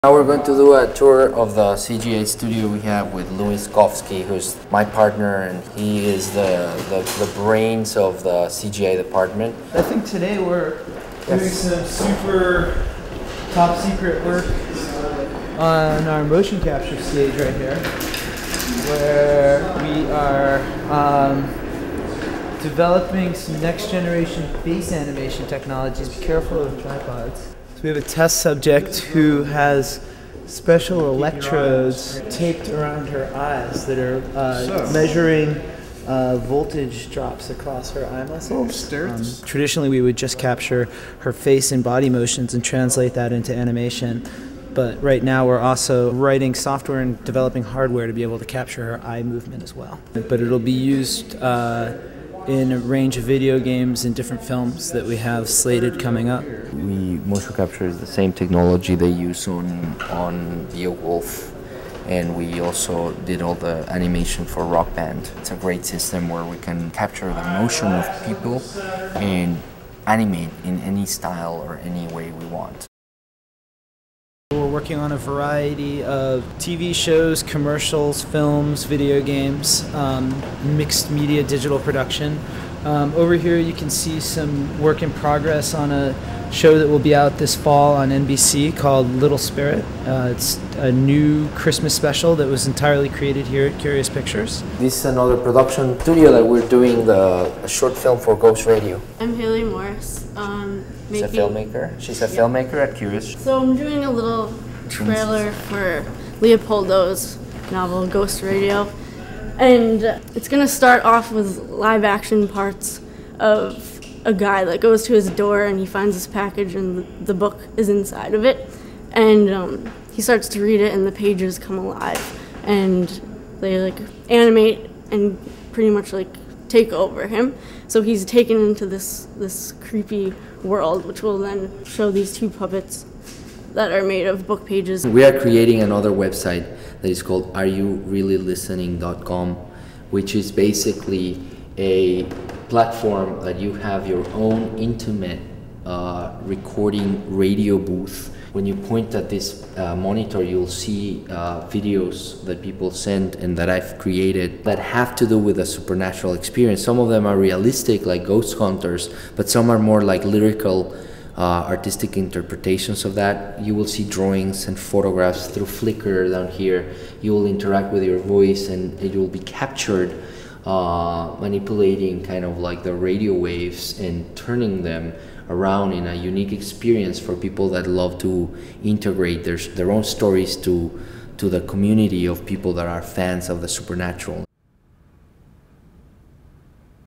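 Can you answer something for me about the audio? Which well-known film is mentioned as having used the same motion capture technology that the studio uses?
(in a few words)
Beowulf.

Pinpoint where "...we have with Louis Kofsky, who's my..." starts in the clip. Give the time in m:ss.
0:02.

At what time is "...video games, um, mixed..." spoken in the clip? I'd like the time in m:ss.
1:18.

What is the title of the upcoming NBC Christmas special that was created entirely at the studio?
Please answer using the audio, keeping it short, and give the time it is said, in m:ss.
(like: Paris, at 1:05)
Little Spirit, at 1:29.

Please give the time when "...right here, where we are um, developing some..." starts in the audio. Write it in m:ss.
0:17.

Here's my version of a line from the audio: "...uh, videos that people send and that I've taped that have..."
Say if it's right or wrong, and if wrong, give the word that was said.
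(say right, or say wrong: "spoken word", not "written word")
wrong: "created", not "taped".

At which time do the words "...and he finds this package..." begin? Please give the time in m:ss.
1:55.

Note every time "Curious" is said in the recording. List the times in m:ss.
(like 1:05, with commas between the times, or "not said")
1:33, 1:42.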